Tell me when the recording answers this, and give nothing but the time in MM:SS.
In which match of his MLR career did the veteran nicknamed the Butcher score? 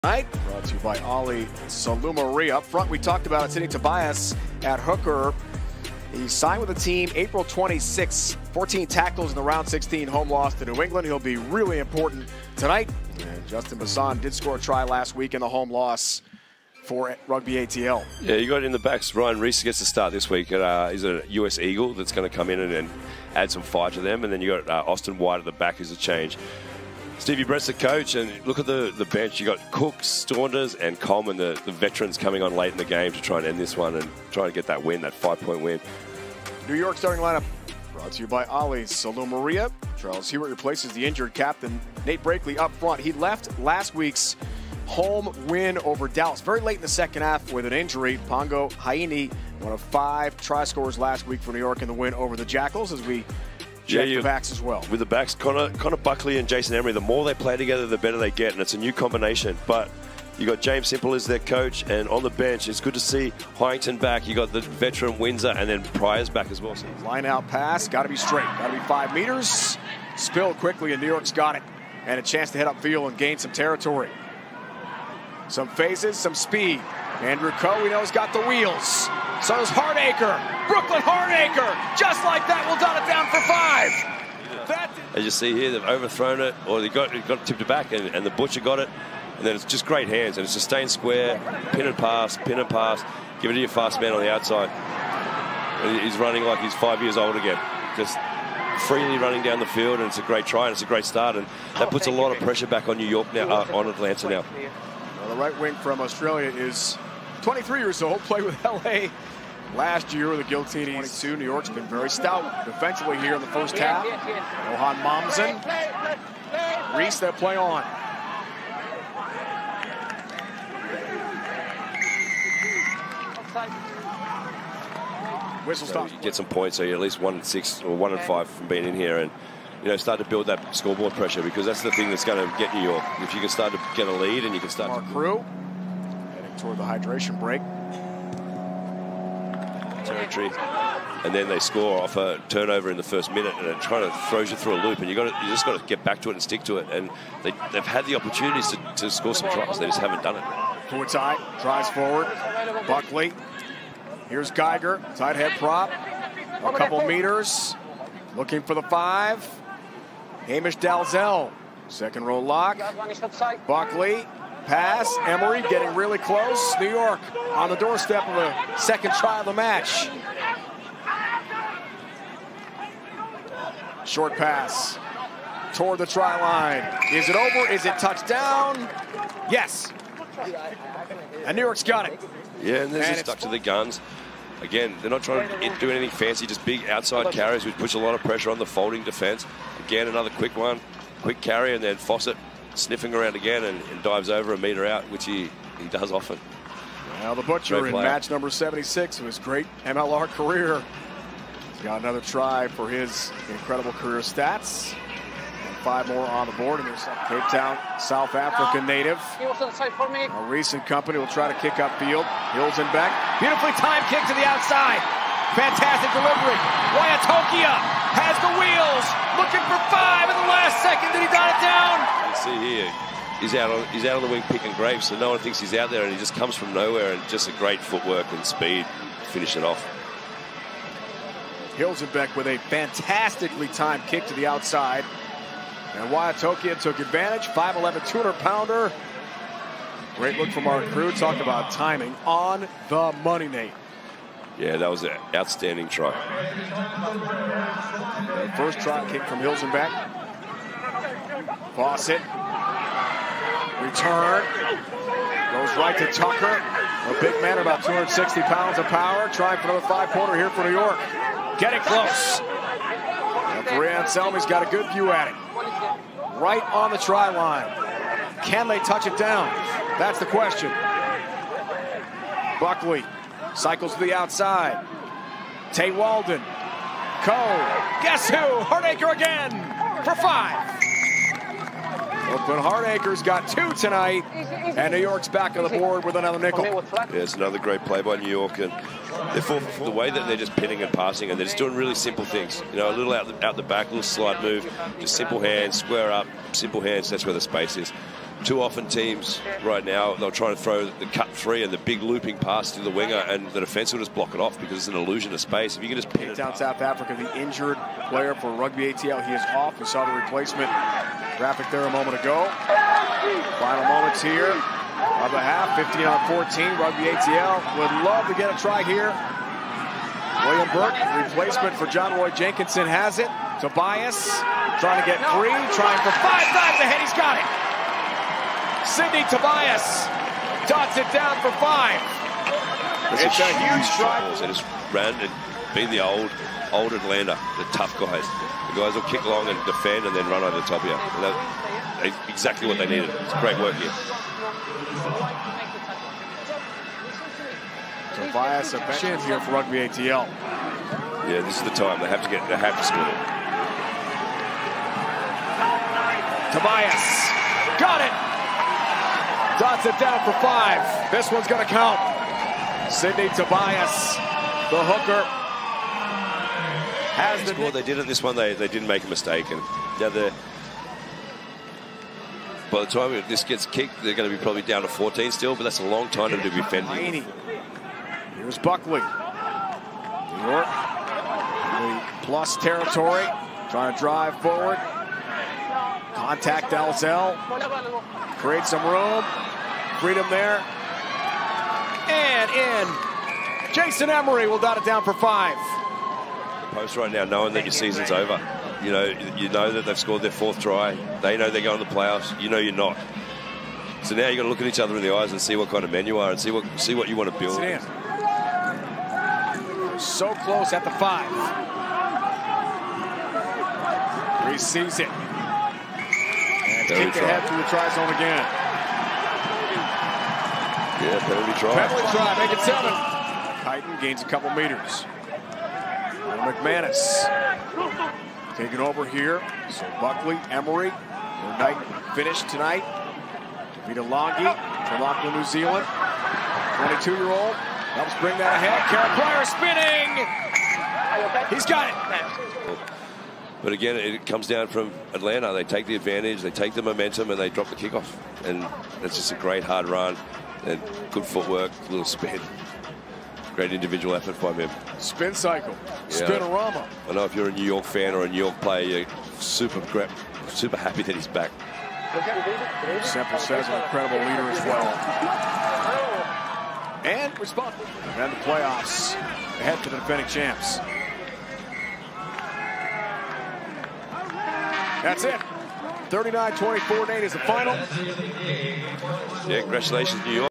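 03:18.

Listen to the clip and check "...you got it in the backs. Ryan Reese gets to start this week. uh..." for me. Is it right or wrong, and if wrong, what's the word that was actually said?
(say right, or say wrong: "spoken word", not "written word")
right.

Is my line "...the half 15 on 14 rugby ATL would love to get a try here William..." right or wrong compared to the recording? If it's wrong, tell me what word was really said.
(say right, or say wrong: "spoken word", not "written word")
right.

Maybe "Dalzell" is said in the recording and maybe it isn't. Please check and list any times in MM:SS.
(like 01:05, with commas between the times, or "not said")
02:40, 06:26.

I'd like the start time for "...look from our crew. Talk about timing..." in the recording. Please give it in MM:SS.
04:00.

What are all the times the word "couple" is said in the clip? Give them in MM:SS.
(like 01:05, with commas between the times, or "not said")
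02:36, 07:04.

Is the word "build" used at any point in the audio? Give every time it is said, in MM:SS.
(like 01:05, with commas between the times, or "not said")
02:10, 06:47.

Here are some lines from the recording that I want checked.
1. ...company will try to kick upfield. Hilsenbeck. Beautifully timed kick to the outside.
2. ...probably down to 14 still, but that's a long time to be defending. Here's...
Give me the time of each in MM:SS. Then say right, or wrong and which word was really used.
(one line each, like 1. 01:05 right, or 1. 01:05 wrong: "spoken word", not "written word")
1. 03:30 right
2. 06:14 right.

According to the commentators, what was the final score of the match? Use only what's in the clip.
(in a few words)
39-24.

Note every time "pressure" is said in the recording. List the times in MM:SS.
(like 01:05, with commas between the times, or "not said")
01:42, 02:11, 03:08.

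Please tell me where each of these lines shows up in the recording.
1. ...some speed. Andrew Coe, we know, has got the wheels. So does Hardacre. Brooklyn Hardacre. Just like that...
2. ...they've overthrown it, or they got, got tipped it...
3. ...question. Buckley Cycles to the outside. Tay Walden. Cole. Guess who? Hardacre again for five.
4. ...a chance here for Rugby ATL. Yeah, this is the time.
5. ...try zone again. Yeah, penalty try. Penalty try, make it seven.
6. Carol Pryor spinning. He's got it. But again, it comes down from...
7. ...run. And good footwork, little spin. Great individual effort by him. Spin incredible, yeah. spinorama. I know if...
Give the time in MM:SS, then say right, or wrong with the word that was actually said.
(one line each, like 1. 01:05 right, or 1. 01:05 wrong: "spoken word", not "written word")
1. 01:16 right
2. 01:25 right
3. 04:30 right
4. 05:48 right
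5. 06:57 right
6. 07:18 right
7. 07:29 wrong: "cycle", not "incredible".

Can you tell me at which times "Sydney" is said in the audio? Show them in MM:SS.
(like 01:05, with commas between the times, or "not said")
05:28, 06:02.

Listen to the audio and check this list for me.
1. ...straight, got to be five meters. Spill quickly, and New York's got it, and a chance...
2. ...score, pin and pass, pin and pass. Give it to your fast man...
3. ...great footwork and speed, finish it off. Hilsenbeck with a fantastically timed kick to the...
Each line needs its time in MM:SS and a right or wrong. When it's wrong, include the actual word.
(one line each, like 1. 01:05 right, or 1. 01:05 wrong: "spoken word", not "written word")
1. 01:08 right
2. 01:30 wrong: "square", not "score"
3. 03:47 right.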